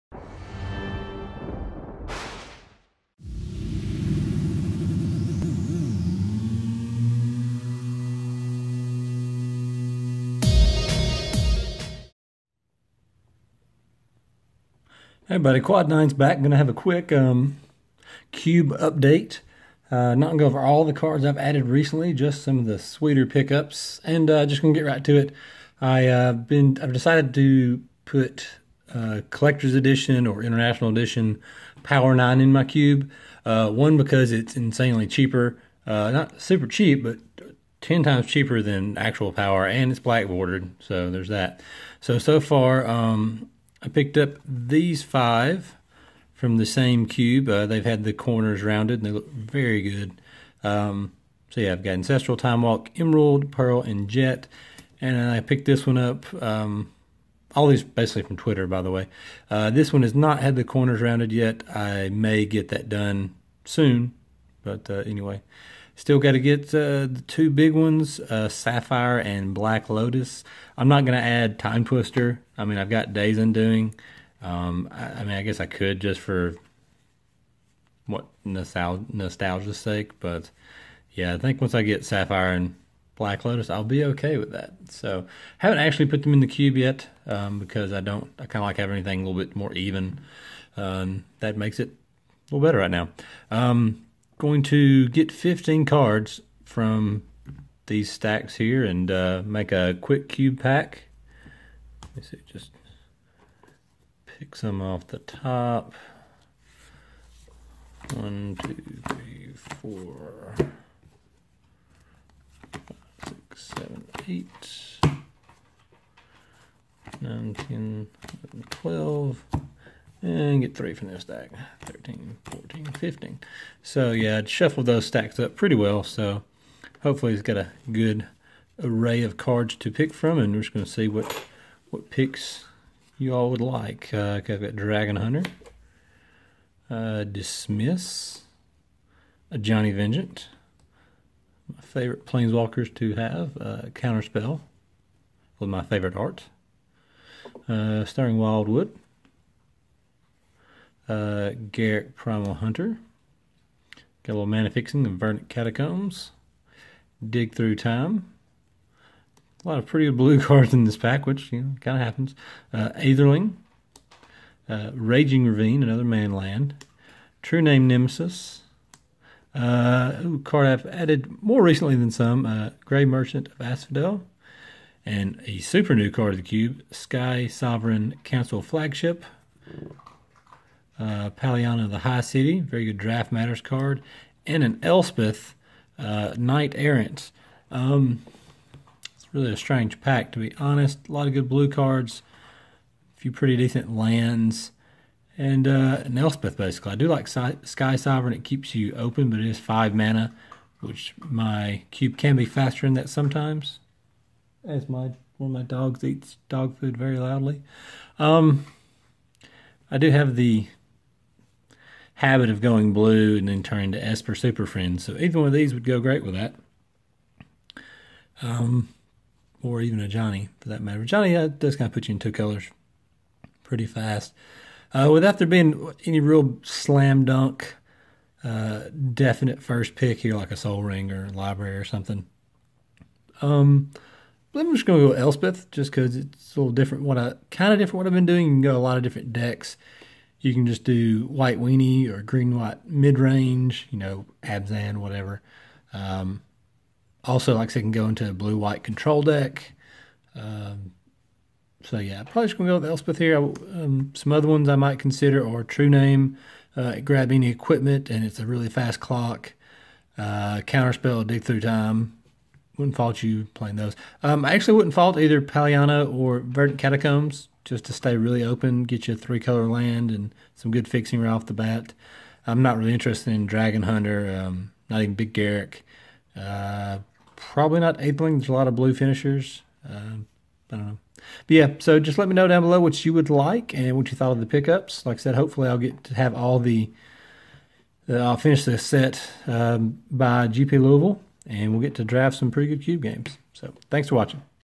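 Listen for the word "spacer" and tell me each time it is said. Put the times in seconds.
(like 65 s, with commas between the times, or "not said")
not said.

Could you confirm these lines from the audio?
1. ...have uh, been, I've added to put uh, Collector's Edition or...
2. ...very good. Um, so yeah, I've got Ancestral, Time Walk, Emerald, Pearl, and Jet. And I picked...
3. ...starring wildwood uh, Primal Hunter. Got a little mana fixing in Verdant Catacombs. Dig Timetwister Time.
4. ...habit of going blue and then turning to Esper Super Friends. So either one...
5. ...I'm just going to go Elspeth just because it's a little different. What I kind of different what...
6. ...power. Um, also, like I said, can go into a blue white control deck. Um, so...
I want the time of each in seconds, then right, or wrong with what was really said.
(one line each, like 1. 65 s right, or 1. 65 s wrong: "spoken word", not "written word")
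1. 26 s wrong: "decided", not "added"
2. 49 s right
3. 148 s wrong: "Through", not "Timetwister"
4. 212 s right
5. 234 s right
6. 244 s wrong: "whatever", not "power".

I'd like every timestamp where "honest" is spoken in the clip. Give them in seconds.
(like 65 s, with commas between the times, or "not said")
190 s.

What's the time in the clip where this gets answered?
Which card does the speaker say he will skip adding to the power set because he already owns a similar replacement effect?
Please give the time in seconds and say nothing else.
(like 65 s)
71 s.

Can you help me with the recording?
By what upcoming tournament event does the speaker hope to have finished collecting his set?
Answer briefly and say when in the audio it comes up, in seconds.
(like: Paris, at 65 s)
GP Louisville, at 290 s.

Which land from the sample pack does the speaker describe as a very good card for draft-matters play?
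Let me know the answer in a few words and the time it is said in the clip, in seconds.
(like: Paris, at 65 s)
Paliano the High City, at 181 s.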